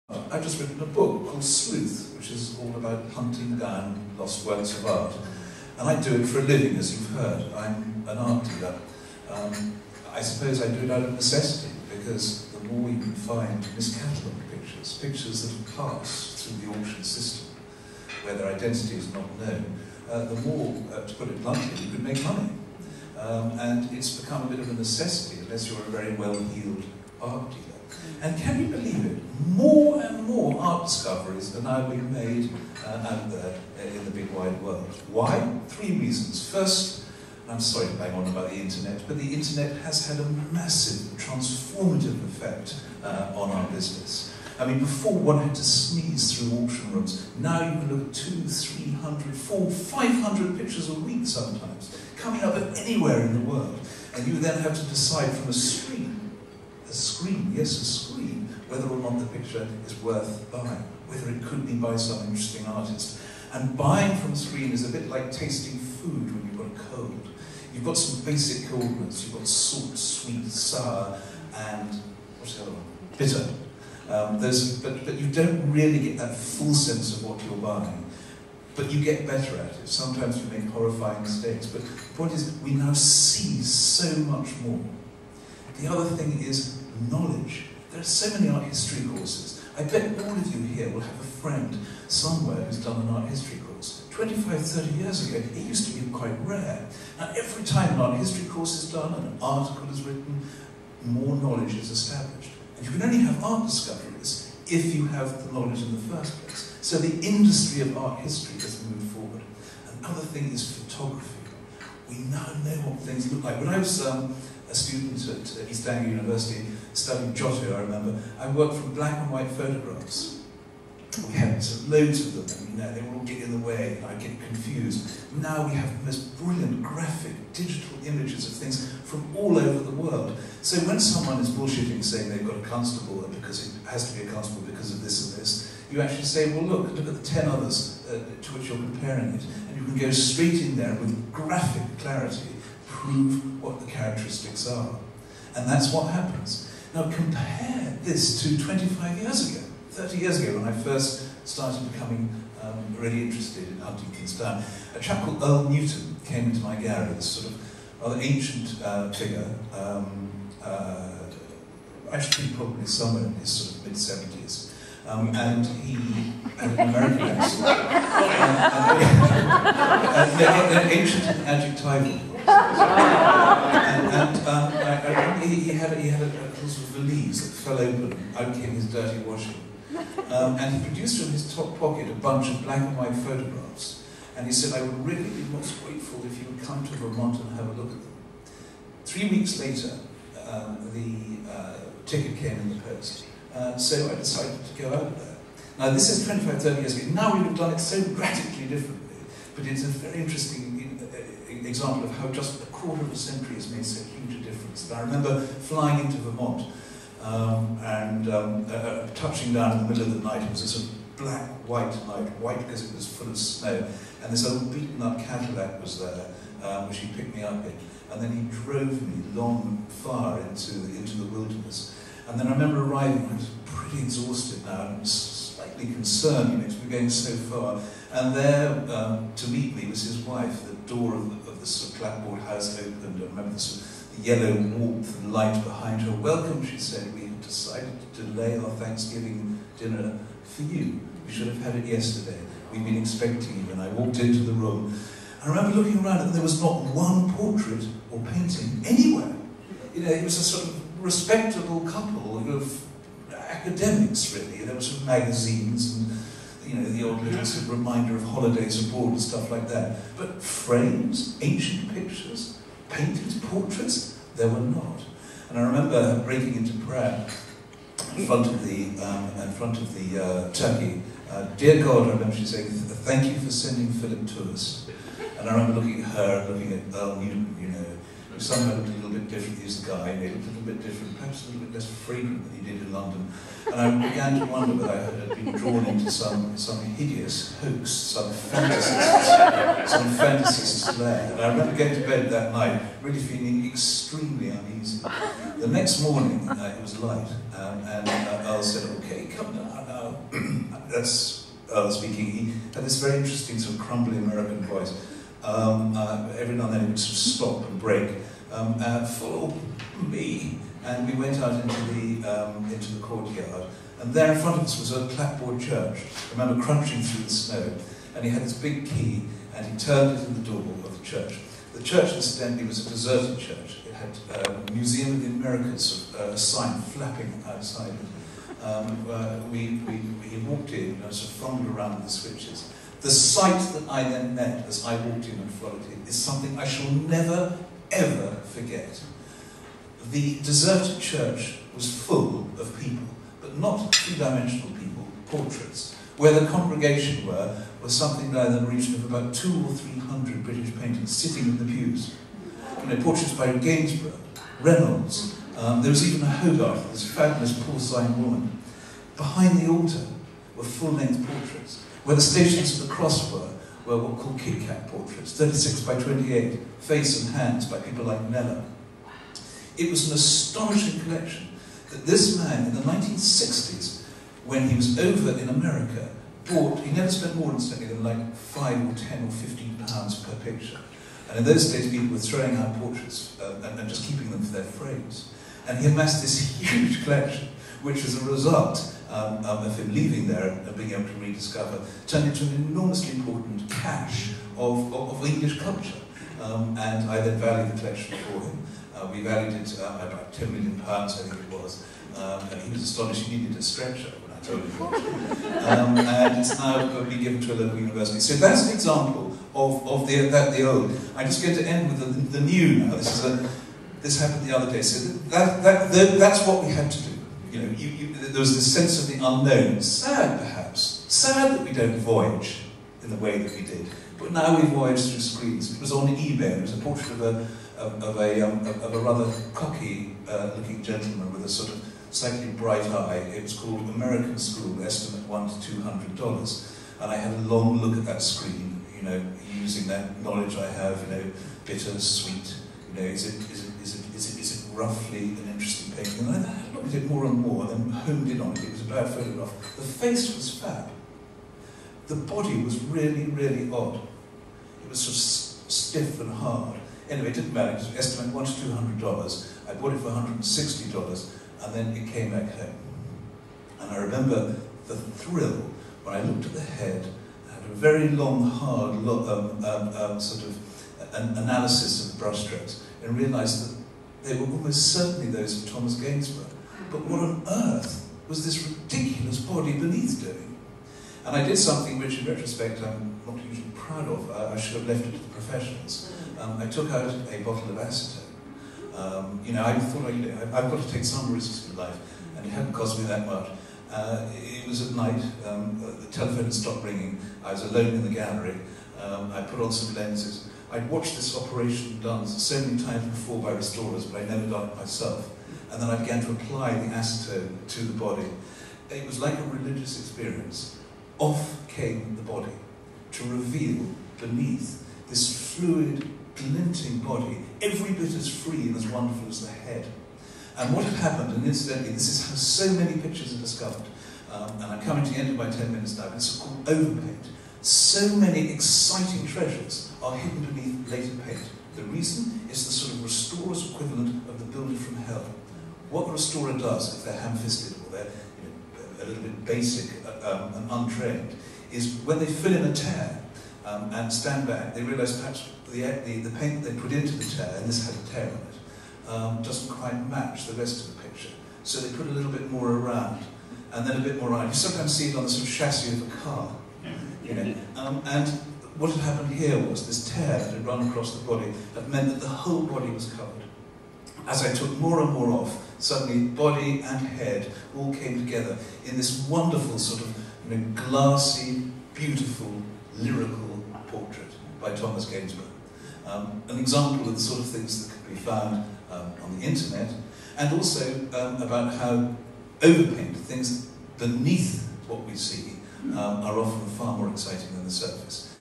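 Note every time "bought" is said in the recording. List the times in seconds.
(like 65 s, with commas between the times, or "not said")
376 s, 459 s.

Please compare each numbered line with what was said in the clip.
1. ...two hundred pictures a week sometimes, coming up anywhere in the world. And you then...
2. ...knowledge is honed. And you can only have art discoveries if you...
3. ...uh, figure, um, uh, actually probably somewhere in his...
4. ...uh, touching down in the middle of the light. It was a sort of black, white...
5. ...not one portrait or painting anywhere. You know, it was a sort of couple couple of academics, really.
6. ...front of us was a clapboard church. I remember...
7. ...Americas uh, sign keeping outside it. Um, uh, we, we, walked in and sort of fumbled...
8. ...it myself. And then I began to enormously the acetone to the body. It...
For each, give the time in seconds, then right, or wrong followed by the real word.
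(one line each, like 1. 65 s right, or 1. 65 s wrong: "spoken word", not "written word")
1. 49 s wrong: "five", not "two"
2. 101 s wrong: "established", not "honed"
3. 158 s right
4. 208 s wrong: "night", not "light"
5. 246 s wrong: "respectable", not "couple"
6. 314 s right
7. 325 s wrong: "flapping", not "keeping"
8. 504 s wrong: "apply", not "enormously".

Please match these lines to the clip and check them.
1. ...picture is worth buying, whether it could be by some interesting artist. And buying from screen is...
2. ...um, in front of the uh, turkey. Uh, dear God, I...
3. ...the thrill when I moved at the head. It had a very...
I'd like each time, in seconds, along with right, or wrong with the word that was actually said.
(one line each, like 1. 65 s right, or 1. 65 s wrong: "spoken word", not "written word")
1. 59 s right
2. 269 s right
3. 464 s wrong: "looked", not "moved".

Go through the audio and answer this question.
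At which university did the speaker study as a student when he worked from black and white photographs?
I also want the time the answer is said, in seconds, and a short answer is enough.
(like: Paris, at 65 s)
East Anglia University, at 115 s.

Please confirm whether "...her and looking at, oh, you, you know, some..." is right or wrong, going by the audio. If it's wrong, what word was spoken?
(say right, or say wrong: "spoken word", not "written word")
right.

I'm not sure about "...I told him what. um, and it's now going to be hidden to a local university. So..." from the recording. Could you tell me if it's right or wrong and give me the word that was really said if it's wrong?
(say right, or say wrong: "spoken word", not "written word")
wrong: "given", not "hidden".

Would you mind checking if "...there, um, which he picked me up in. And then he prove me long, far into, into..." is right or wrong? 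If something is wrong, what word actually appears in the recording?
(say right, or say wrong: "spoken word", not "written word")
wrong: "drove", not "prove".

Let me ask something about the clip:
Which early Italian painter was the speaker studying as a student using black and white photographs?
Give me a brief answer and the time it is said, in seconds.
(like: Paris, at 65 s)
Giotto, at 117 s.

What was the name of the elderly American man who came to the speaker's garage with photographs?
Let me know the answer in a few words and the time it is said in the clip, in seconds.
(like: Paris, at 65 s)
Earl Newton, at 155 s.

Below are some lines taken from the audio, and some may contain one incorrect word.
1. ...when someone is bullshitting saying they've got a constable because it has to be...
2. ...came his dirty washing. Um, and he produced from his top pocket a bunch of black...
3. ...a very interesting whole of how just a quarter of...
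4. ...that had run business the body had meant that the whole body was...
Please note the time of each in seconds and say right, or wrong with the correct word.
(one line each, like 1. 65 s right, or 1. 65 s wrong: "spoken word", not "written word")
1. 130 s right
2. 178 s right
3. 199 s wrong: "example", not "whole"
4. 560 s wrong: "across", not "business".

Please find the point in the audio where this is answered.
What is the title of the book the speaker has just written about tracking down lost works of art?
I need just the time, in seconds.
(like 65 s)
1 s.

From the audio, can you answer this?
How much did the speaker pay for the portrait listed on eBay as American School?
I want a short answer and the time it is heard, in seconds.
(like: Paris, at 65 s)
$160, at 460 s.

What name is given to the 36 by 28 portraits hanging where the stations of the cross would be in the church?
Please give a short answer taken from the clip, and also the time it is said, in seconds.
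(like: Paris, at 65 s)
Kit Kat portraits, at 364 s.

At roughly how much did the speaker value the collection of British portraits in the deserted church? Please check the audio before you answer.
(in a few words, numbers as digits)
10 million pounds.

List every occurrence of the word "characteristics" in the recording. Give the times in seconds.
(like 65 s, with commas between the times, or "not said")
143 s.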